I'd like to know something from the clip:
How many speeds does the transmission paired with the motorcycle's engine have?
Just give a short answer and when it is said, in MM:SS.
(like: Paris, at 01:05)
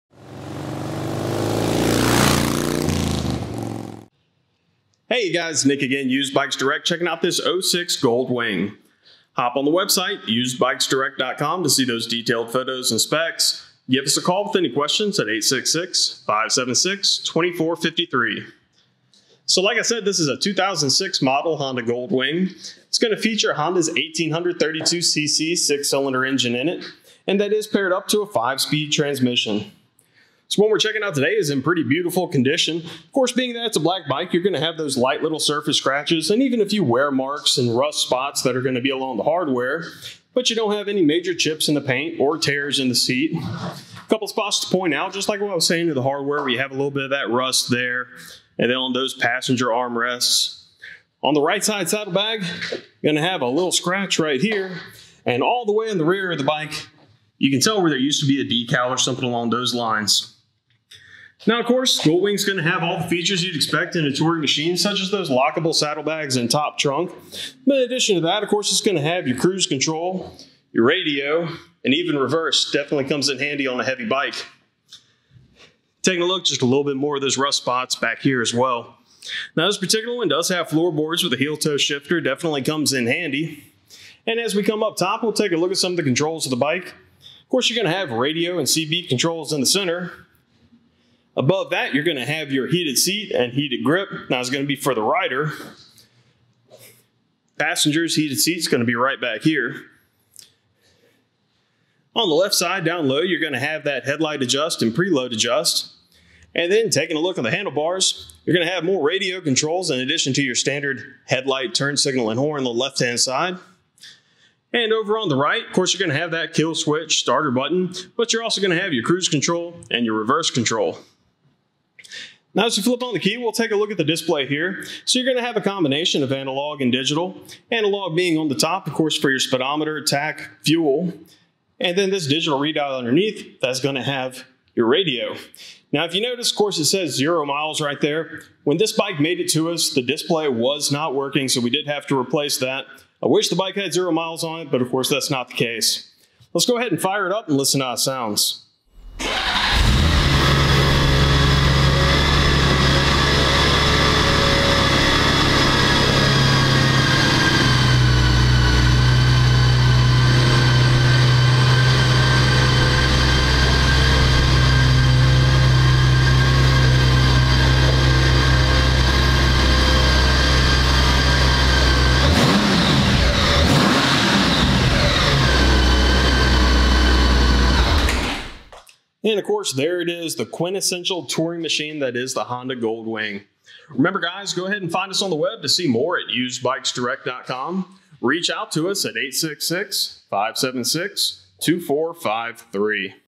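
5, at 00:28.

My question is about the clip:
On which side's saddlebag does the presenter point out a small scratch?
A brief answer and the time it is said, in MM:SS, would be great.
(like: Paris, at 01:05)
Right side, at 00:51.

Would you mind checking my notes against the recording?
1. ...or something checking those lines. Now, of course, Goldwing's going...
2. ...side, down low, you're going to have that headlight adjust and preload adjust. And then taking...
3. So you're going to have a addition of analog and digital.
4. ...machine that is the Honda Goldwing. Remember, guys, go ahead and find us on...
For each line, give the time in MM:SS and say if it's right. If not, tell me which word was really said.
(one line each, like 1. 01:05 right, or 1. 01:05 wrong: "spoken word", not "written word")
1. 00:58 wrong: "along", not "checking"
2. 01:42 right
3. 02:05 wrong: "combination", not "addition"
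4. 03:01 right.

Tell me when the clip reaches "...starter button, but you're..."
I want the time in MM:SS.
01:57.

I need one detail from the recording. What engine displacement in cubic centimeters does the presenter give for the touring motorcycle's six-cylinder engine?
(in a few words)
1832cc.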